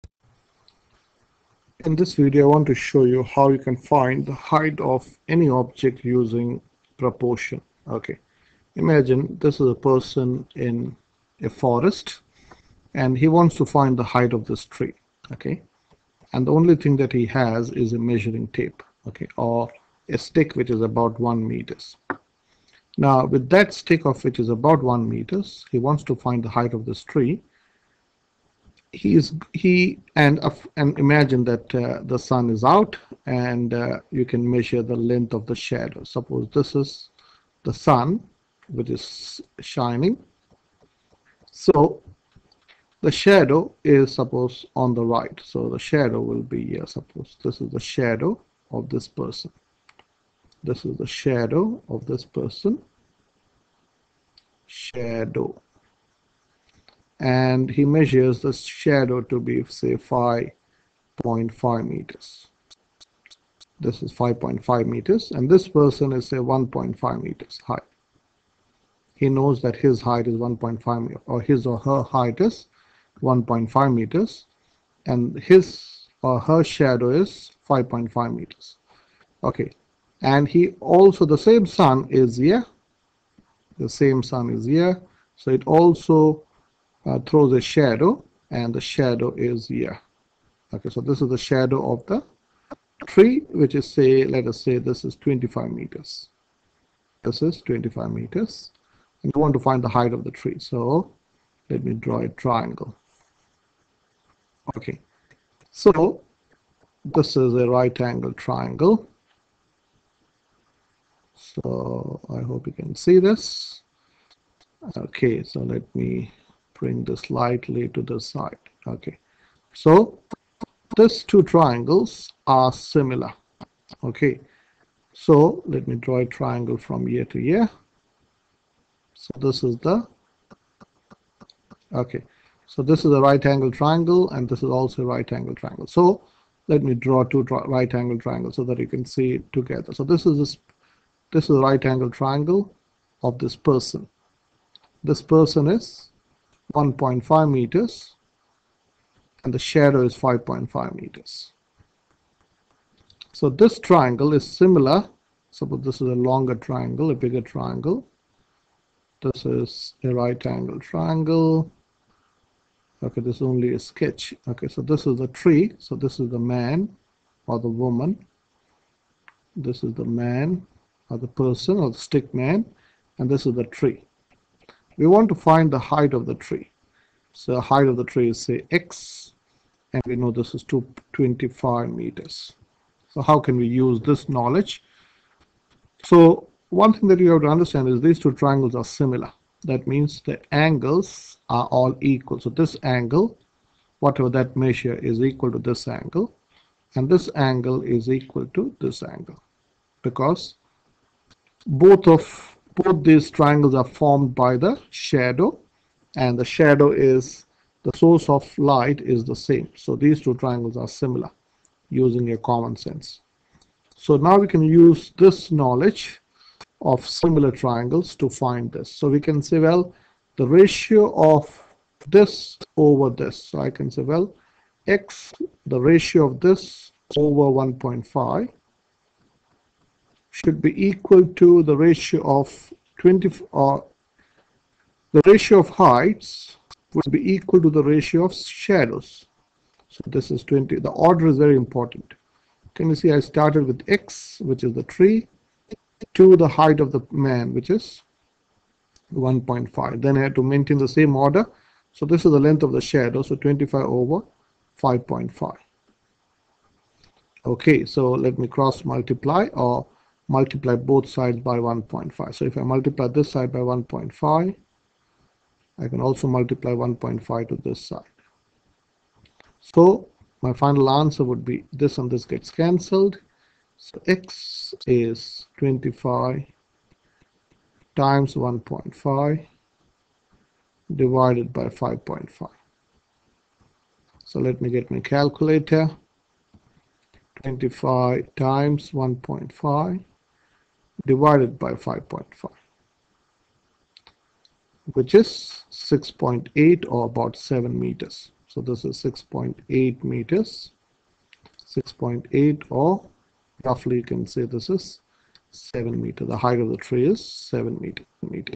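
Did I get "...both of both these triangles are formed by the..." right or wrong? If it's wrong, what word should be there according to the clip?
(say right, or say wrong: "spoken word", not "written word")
right.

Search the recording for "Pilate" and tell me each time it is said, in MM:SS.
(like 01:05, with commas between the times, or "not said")
not said.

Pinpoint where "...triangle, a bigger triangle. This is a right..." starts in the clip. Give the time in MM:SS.
02:36.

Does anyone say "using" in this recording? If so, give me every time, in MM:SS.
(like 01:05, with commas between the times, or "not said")
00:06, 03:31.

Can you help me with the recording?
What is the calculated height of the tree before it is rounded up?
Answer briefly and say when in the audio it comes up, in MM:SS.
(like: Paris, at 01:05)
6.8 meters, at 04:59.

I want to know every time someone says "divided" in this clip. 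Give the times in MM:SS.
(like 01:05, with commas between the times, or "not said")
04:40, 04:51.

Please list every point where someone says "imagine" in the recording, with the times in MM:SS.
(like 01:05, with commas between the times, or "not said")
00:08, 00:30.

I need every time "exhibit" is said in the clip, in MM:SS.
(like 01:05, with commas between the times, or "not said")
not said.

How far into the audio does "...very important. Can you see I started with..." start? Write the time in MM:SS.
04:01.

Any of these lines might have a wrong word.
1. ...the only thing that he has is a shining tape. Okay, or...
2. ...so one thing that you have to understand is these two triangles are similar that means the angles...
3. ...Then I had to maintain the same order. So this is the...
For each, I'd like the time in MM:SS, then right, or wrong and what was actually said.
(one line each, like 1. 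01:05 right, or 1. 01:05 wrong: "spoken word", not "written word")
1. 00:16 wrong: "measuring", not "shining"
2. 03:06 right
3. 04:10 right.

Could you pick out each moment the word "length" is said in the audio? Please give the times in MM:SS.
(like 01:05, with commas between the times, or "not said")
00:34, 04:12.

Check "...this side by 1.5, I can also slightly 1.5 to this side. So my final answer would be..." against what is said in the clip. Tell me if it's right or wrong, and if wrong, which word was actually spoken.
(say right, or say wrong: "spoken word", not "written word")
wrong: "multiply", not "slightly".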